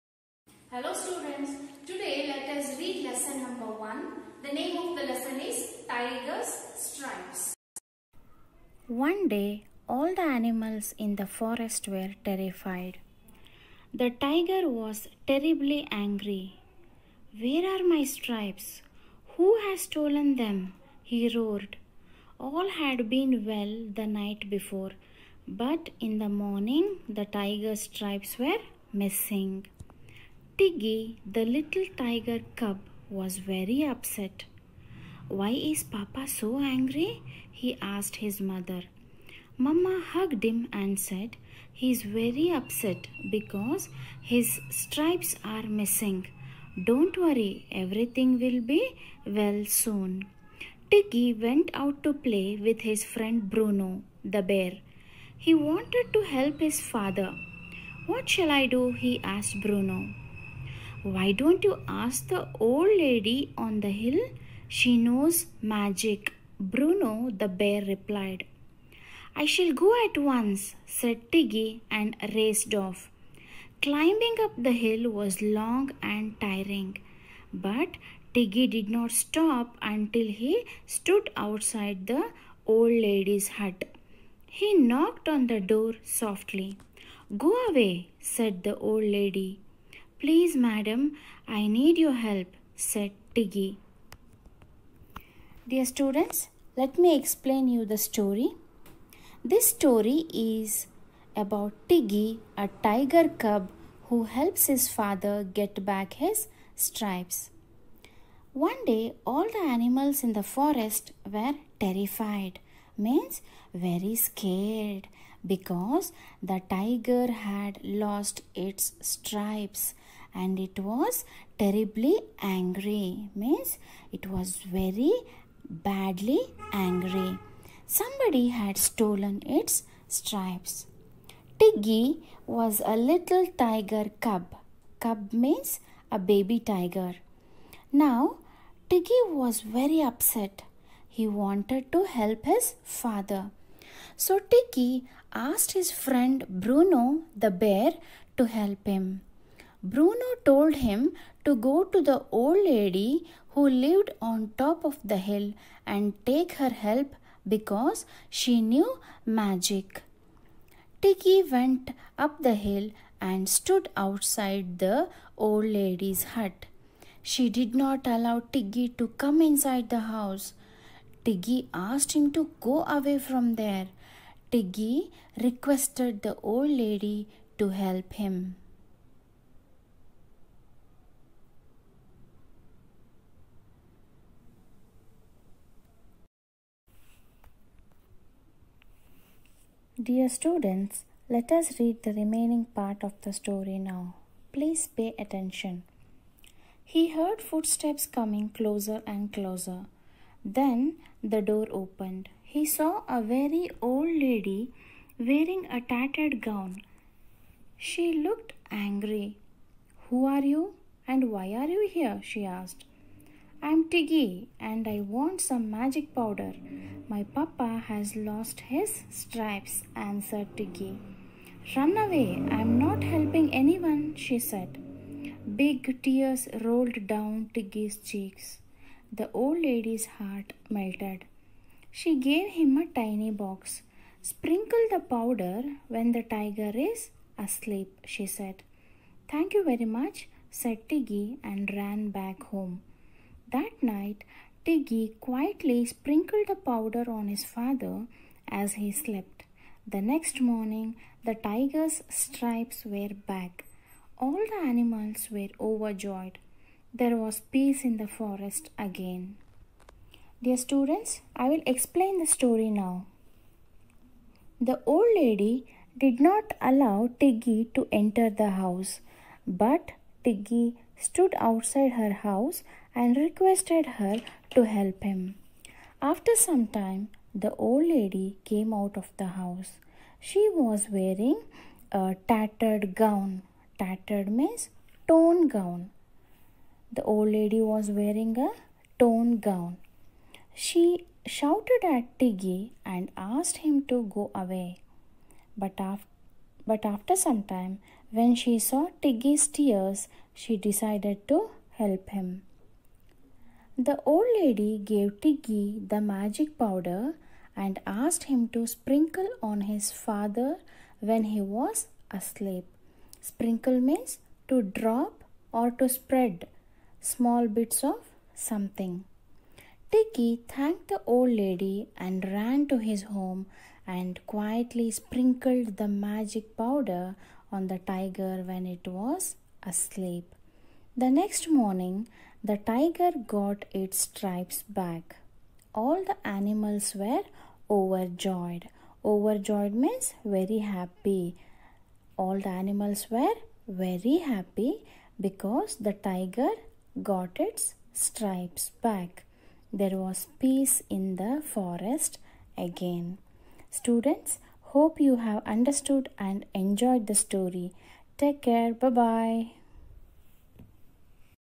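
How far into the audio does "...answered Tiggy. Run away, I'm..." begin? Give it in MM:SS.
03:39.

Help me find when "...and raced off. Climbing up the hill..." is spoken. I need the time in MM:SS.
01:11.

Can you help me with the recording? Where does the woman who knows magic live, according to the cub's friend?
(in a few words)
on the hill.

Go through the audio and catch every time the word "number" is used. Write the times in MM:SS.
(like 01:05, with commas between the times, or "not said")
00:03.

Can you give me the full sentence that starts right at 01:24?
He knocked on the door softly.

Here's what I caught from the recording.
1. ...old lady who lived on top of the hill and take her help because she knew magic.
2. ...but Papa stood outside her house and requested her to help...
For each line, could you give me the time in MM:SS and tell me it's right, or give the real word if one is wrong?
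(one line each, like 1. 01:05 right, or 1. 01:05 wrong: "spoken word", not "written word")
1. 02:32 right
2. 04:29 wrong: "Tiggy", not "Papa".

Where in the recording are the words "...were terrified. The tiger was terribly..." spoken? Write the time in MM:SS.
00:11.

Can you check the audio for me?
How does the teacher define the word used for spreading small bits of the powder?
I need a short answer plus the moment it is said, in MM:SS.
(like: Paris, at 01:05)
to drop or to spread small bits, at 05:14.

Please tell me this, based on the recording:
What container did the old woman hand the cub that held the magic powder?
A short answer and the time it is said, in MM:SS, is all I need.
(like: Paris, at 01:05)
a tiny box, at 03:52.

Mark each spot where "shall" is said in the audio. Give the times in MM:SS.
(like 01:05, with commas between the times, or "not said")
00:58, 01:09.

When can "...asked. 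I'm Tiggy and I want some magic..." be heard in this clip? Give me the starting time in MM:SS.
03:32.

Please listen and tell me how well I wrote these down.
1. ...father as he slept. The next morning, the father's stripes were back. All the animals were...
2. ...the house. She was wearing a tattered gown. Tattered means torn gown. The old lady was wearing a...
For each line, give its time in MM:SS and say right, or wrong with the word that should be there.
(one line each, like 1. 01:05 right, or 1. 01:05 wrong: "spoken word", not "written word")
1. 04:07 wrong: "tiger", not "father"
2. 04:39 right.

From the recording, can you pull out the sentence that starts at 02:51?
Tiggy asked him to go away from there.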